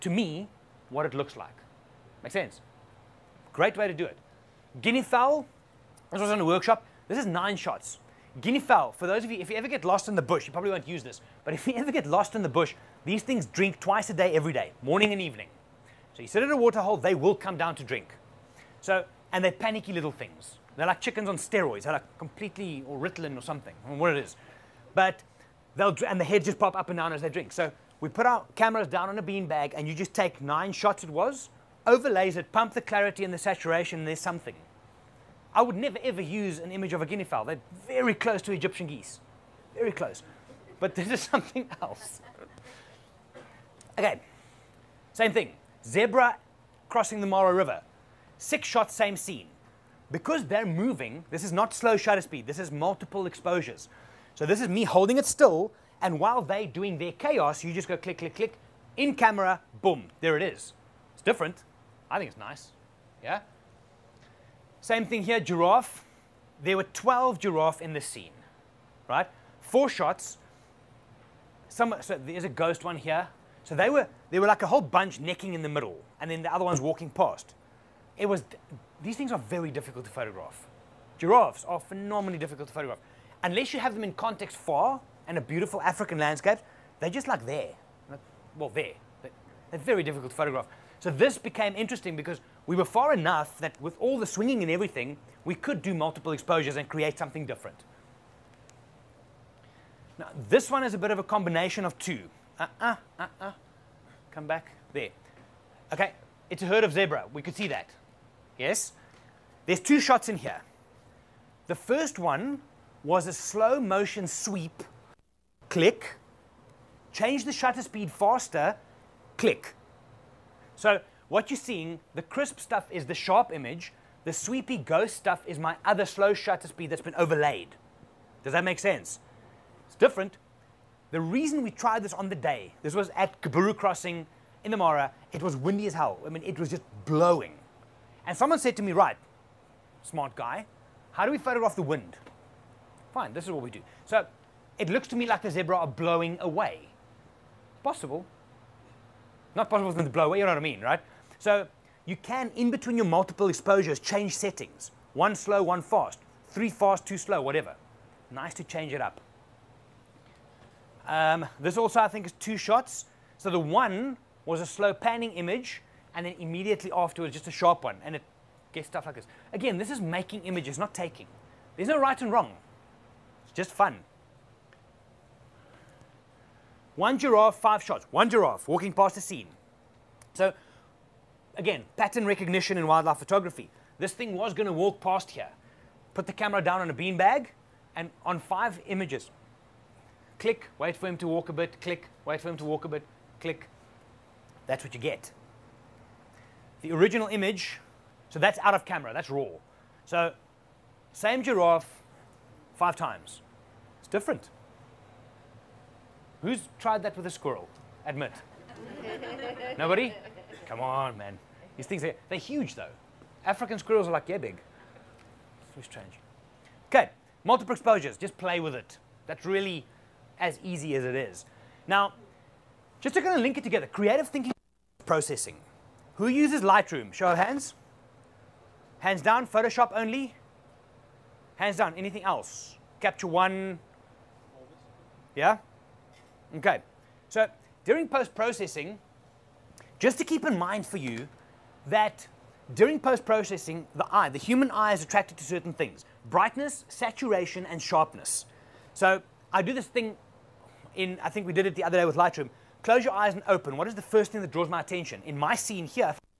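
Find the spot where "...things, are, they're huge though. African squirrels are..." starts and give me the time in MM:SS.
03:31.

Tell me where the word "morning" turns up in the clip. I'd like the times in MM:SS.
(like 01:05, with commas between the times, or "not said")
00:14.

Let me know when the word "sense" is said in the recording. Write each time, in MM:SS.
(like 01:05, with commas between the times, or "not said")
00:02, 02:08.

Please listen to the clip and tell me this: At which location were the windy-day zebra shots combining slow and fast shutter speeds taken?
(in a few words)
Kaburu Crossing.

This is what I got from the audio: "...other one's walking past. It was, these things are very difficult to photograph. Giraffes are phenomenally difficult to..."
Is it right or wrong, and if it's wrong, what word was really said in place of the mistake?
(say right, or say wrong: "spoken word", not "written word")
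right.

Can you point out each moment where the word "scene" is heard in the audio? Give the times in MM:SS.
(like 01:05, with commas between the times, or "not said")
00:49, 01:08, 02:59, 04:15.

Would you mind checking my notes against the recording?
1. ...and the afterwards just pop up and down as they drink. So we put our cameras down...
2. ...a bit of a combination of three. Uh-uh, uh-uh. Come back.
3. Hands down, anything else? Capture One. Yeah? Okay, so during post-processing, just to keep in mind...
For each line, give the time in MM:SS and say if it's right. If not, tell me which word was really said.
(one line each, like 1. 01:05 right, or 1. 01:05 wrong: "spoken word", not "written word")
1. 00:26 wrong: "heads", not "afterwards"
2. 01:40 wrong: "two", not "three"
3. 03:51 right.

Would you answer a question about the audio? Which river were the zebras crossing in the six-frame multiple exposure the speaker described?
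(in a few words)
Mara River.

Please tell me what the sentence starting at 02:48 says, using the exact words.
And it gets stuff like this.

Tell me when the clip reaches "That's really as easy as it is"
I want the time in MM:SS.
03:39.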